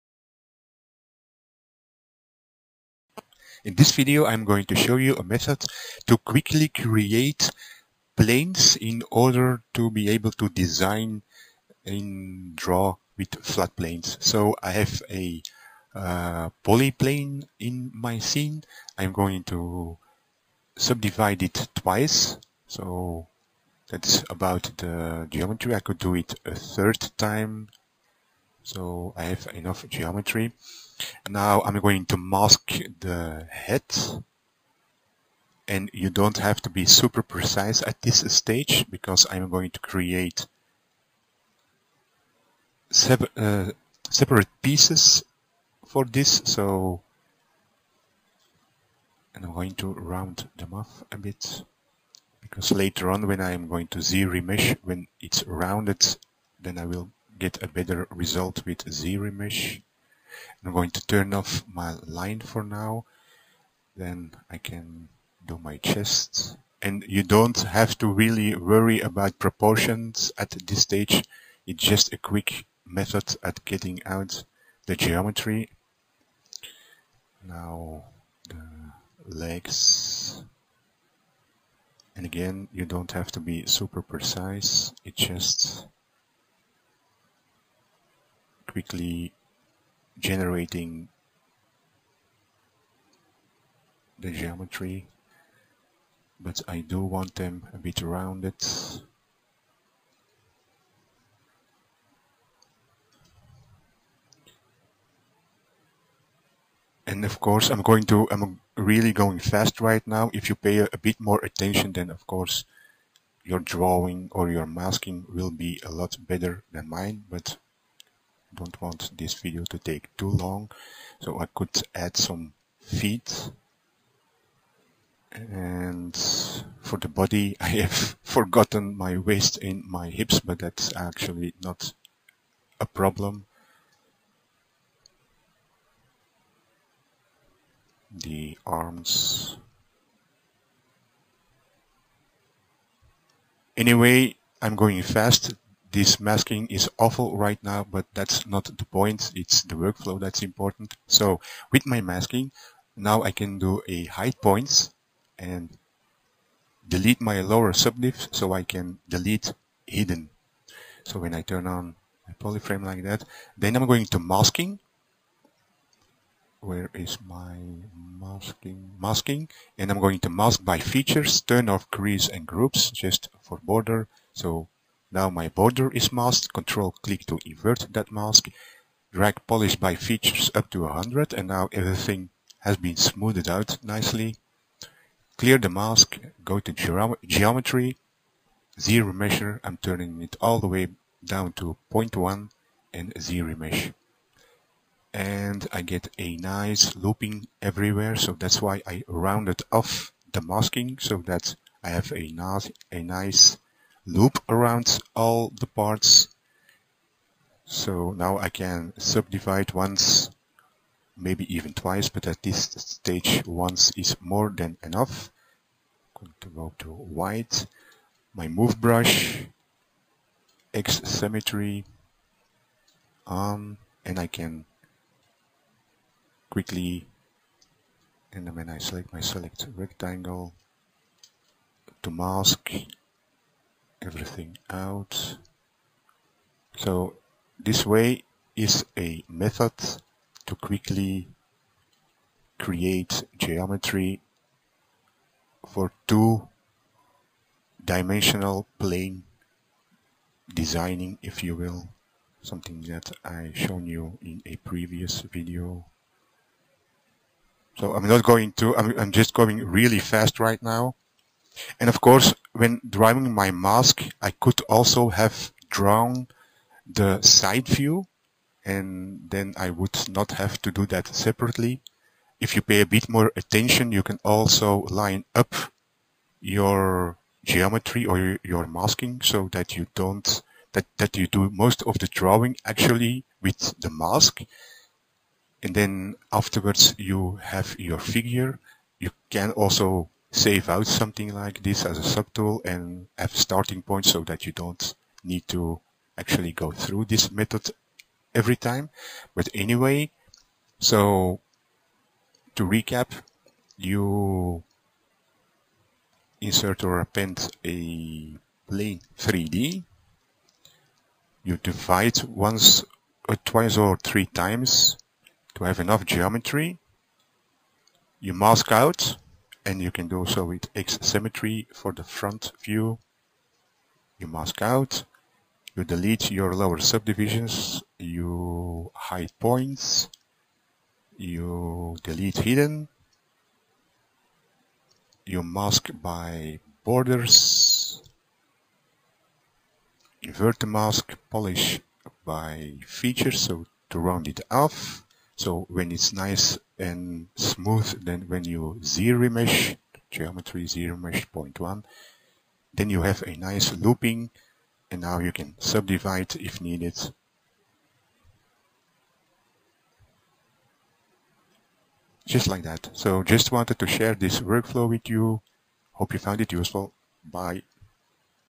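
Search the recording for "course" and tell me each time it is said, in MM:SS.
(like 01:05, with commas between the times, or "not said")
01:47, 01:52, 04:22.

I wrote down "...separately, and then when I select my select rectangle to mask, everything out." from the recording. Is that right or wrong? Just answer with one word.
wrong.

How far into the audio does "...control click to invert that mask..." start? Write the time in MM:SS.
02:56.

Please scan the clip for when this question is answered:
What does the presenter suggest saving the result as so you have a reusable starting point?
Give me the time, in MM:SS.
04:52.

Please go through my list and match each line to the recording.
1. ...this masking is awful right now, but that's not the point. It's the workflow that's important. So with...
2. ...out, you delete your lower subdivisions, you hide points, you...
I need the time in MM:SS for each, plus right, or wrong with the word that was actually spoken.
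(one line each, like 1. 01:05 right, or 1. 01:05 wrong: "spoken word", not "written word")
1. 02:25 right
2. 05:24 right.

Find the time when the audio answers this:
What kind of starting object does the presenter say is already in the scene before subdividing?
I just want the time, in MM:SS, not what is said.
00:16.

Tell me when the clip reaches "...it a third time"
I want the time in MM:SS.
00:26.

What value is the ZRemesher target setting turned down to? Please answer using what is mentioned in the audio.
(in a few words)
0.1.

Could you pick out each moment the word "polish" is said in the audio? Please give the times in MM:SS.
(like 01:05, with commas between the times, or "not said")
02:59, 05:41.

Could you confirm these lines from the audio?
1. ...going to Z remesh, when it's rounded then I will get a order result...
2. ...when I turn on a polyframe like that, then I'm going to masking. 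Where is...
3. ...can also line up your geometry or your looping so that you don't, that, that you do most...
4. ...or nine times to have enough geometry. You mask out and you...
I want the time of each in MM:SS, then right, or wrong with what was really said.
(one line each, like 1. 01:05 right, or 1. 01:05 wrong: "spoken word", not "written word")
1. 00:53 wrong: "better", not "order"
2. 02:41 right
3. 04:34 wrong: "masking", not "looping"
4. 05:13 wrong: "three", not "nine".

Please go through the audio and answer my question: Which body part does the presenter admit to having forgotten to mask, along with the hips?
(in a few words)
waist.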